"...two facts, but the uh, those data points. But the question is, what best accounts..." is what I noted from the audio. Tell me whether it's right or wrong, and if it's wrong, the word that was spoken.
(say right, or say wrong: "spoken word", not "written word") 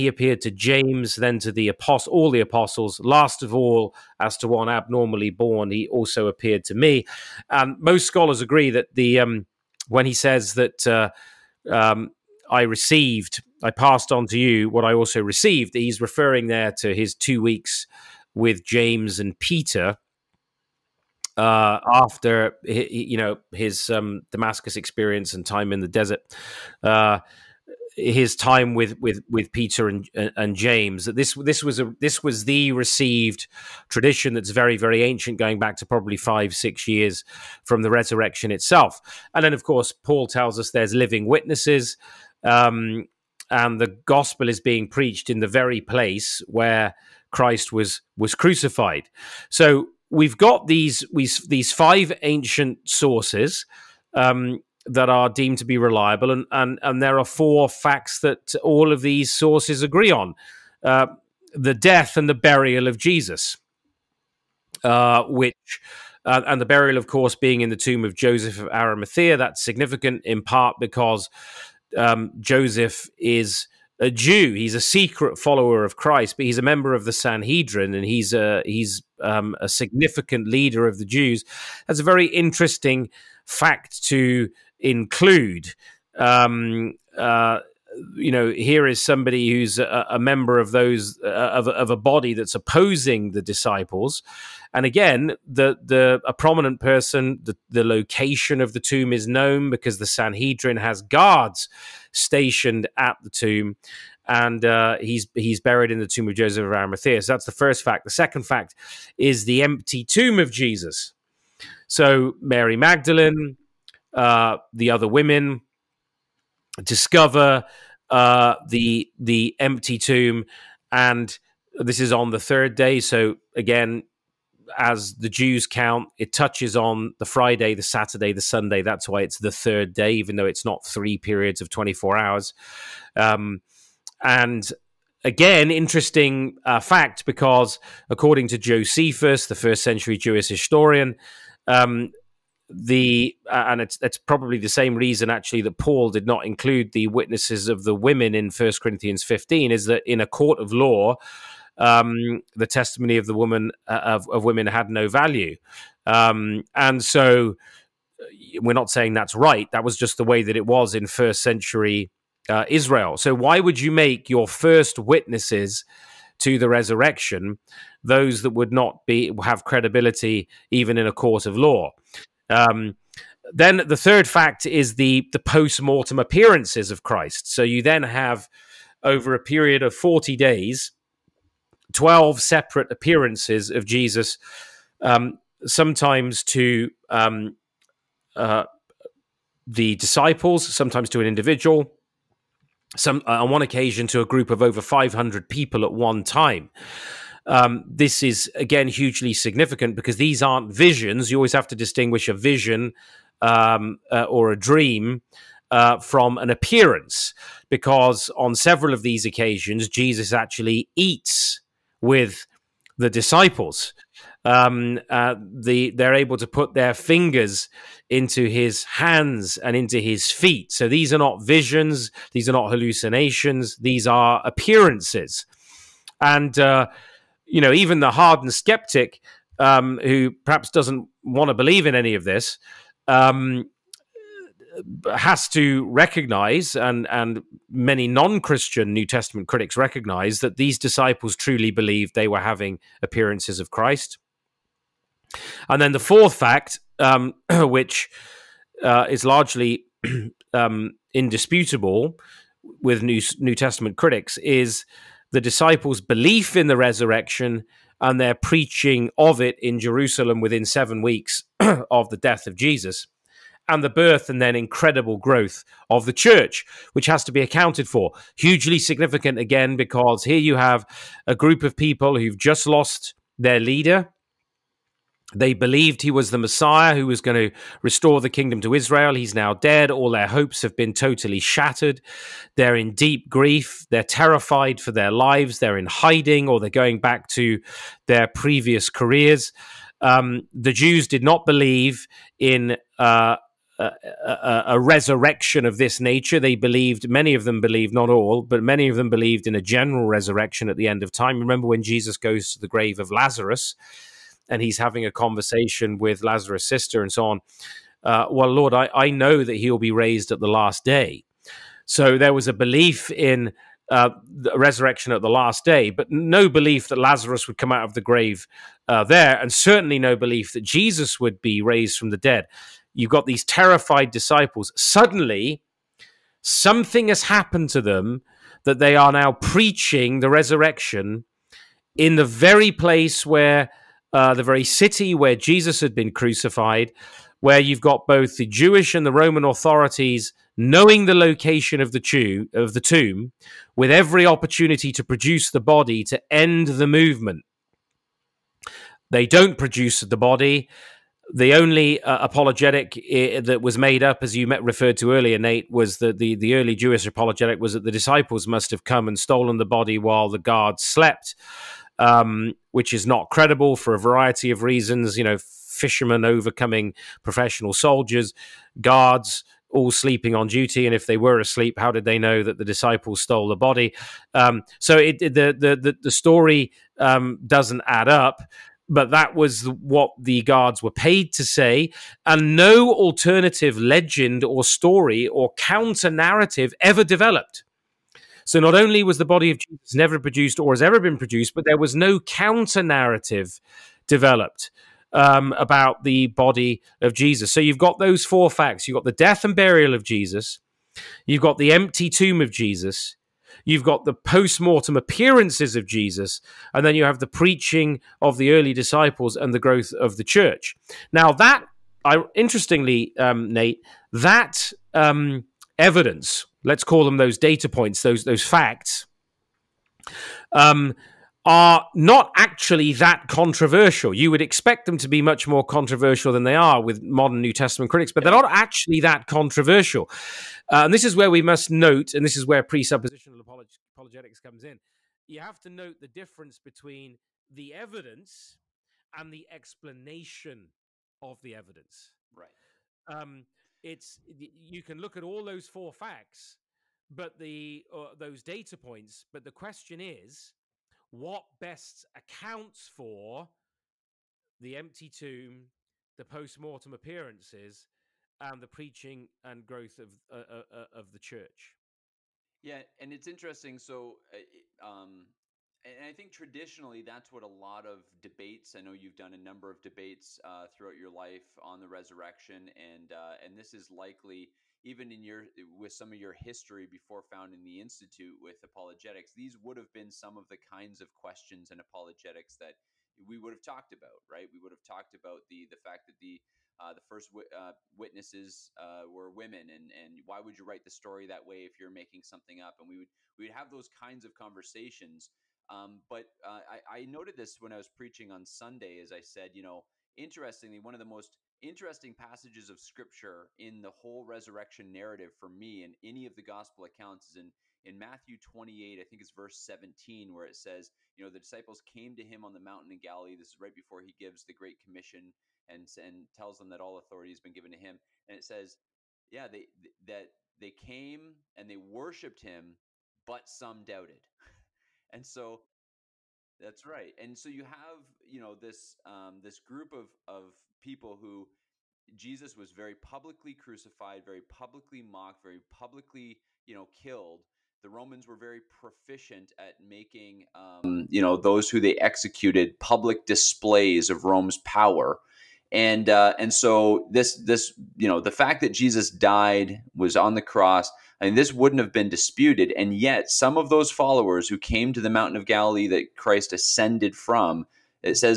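wrong: "four", not "two".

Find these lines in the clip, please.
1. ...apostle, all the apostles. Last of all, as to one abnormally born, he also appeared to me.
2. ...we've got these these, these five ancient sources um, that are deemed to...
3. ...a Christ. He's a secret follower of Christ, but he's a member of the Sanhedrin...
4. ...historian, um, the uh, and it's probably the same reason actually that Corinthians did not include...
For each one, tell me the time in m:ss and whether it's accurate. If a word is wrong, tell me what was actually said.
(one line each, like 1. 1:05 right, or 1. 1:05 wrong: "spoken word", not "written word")
1. 0:01 right
2. 0:50 right
3. 1:13 wrong: "Jew", not "Christ"
4. 2:20 wrong: "Paul", not "Corinthians".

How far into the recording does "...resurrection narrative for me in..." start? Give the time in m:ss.
8:24.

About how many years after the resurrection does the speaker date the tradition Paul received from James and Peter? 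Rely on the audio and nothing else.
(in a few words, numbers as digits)
5 6 years.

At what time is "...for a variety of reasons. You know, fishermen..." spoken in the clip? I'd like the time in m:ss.
6:03.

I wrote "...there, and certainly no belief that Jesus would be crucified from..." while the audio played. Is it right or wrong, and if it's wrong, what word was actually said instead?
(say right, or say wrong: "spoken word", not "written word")
wrong: "raised", not "crucified".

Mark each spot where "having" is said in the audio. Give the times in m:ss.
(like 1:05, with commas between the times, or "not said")
4:02, 5:04.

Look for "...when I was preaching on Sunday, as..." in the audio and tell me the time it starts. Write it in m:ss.
8:17.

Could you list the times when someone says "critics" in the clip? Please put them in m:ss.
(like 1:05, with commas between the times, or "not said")
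3:59, 4:13, 7:07.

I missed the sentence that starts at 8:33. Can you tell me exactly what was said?
This is right before he gives the Great Commission and, and tells them that all authority has been given to him.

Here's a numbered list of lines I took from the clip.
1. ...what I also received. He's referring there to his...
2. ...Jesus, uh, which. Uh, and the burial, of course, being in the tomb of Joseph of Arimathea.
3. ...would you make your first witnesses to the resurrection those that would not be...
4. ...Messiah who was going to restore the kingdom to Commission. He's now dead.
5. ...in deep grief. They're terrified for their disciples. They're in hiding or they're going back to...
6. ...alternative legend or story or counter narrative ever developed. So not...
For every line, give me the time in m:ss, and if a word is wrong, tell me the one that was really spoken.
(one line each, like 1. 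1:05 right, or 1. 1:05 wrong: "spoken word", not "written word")
1. 0:14 right
2. 1:02 right
3. 2:43 right
4. 4:36 wrong: "Israel", not "Commission"
5. 4:42 wrong: "lives", not "disciples"
6. 6:22 right.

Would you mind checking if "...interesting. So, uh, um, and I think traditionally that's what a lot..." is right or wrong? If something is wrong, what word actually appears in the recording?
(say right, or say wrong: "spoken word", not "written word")
right.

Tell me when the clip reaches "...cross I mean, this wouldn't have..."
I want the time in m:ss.
9:10.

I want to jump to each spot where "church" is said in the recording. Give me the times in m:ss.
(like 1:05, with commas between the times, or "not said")
4:26, 6:50, 7:41.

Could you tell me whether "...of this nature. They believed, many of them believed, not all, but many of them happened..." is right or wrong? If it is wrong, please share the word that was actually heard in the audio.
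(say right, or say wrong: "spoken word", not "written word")
wrong: "believed", not "happened".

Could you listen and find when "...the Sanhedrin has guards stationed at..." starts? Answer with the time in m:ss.
1:39.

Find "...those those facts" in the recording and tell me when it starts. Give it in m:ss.
6:58.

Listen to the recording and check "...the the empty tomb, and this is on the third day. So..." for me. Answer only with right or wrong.
right.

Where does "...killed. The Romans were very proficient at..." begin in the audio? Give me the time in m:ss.
8:56.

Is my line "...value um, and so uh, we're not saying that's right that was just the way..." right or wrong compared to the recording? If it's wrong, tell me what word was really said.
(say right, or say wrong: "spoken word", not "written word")
right.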